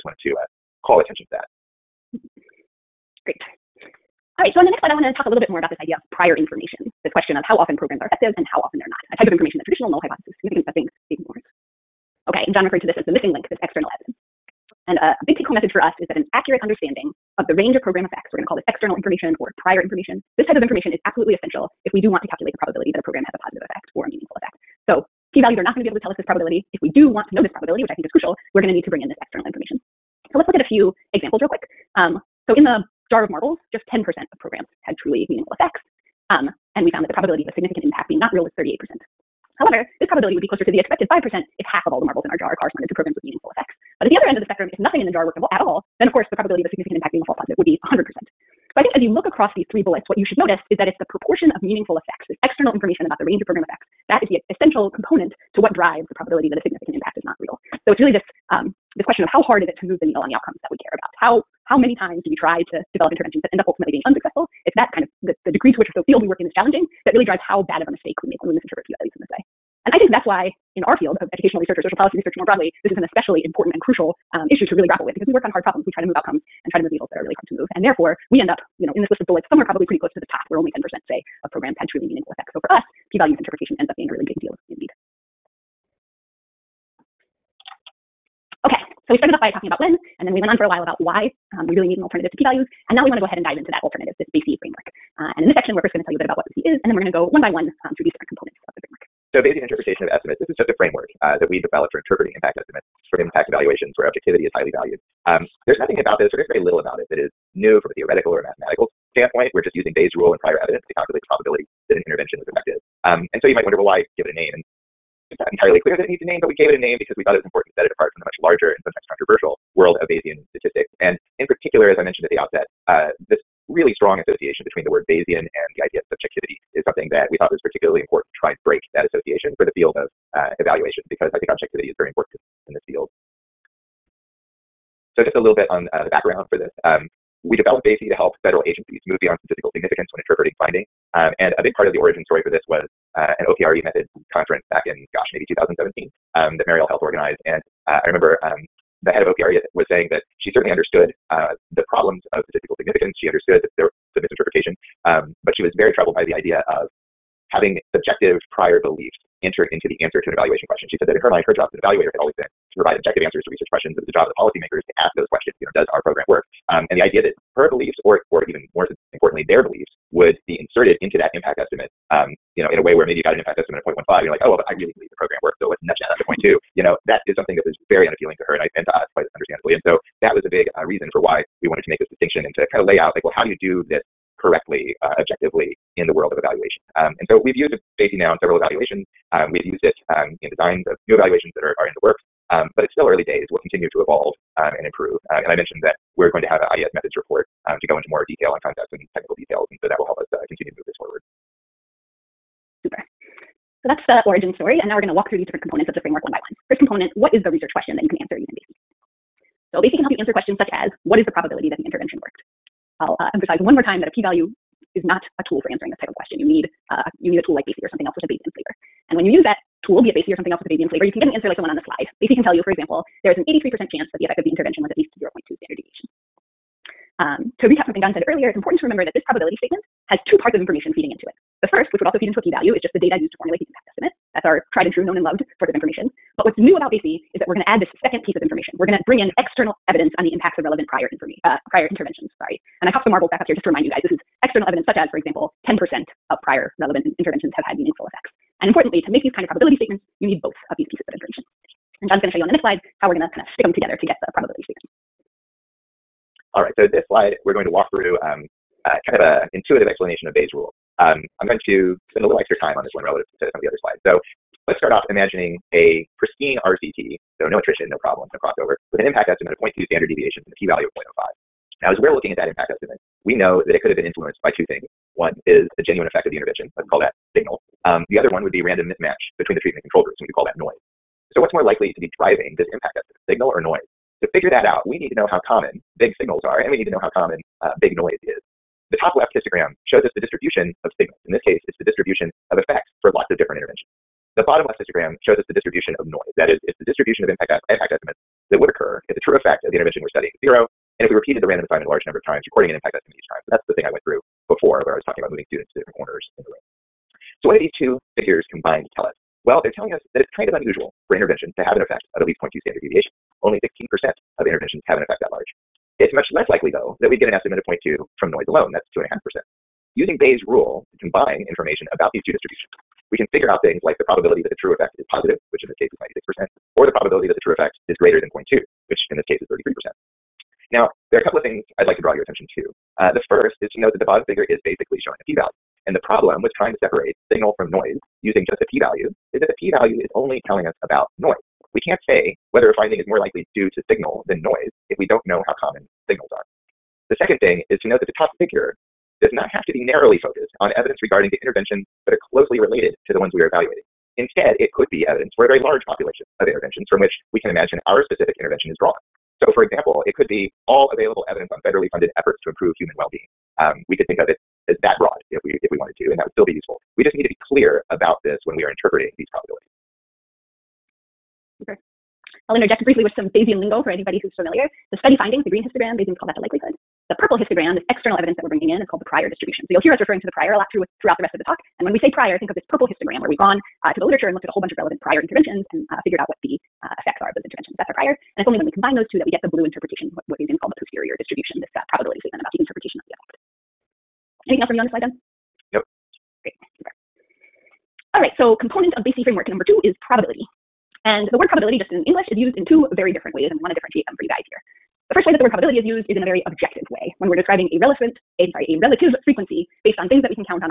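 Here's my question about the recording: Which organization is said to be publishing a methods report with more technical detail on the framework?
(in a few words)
IES.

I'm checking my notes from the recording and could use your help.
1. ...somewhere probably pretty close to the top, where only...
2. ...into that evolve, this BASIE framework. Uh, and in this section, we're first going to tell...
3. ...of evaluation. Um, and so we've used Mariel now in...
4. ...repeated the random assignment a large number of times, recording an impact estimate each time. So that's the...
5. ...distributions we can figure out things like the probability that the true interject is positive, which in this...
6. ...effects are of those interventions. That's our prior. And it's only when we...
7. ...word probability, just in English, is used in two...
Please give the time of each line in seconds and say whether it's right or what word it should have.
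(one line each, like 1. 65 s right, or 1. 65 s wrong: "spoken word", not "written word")
1. 79 s right
2. 93 s wrong: "alternative", not "evolve"
3. 186 s wrong: "BASIE", not "Mariel"
4. 301 s right
5. 322 s wrong: "effect", not "interject"
6. 386 s right
7. 401 s right.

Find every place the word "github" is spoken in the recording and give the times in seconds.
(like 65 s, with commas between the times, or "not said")
not said.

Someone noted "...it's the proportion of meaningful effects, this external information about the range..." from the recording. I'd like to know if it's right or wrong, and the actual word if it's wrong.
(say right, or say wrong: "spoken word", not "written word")
right.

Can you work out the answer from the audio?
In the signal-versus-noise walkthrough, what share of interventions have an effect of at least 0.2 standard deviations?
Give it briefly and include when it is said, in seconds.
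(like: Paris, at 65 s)
16%, at 313 s.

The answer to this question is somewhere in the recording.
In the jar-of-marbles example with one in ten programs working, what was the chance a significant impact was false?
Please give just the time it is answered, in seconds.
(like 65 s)
38 s.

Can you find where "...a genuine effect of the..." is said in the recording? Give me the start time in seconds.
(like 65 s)
275 s.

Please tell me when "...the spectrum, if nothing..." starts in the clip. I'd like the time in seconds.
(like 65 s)
44 s.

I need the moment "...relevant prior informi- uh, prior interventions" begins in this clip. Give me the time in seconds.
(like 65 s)
240 s.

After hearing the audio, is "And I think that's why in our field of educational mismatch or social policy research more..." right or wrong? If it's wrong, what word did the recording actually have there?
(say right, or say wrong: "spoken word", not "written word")
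wrong: "research", not "mismatch".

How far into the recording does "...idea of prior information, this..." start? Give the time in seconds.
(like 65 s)
5 s.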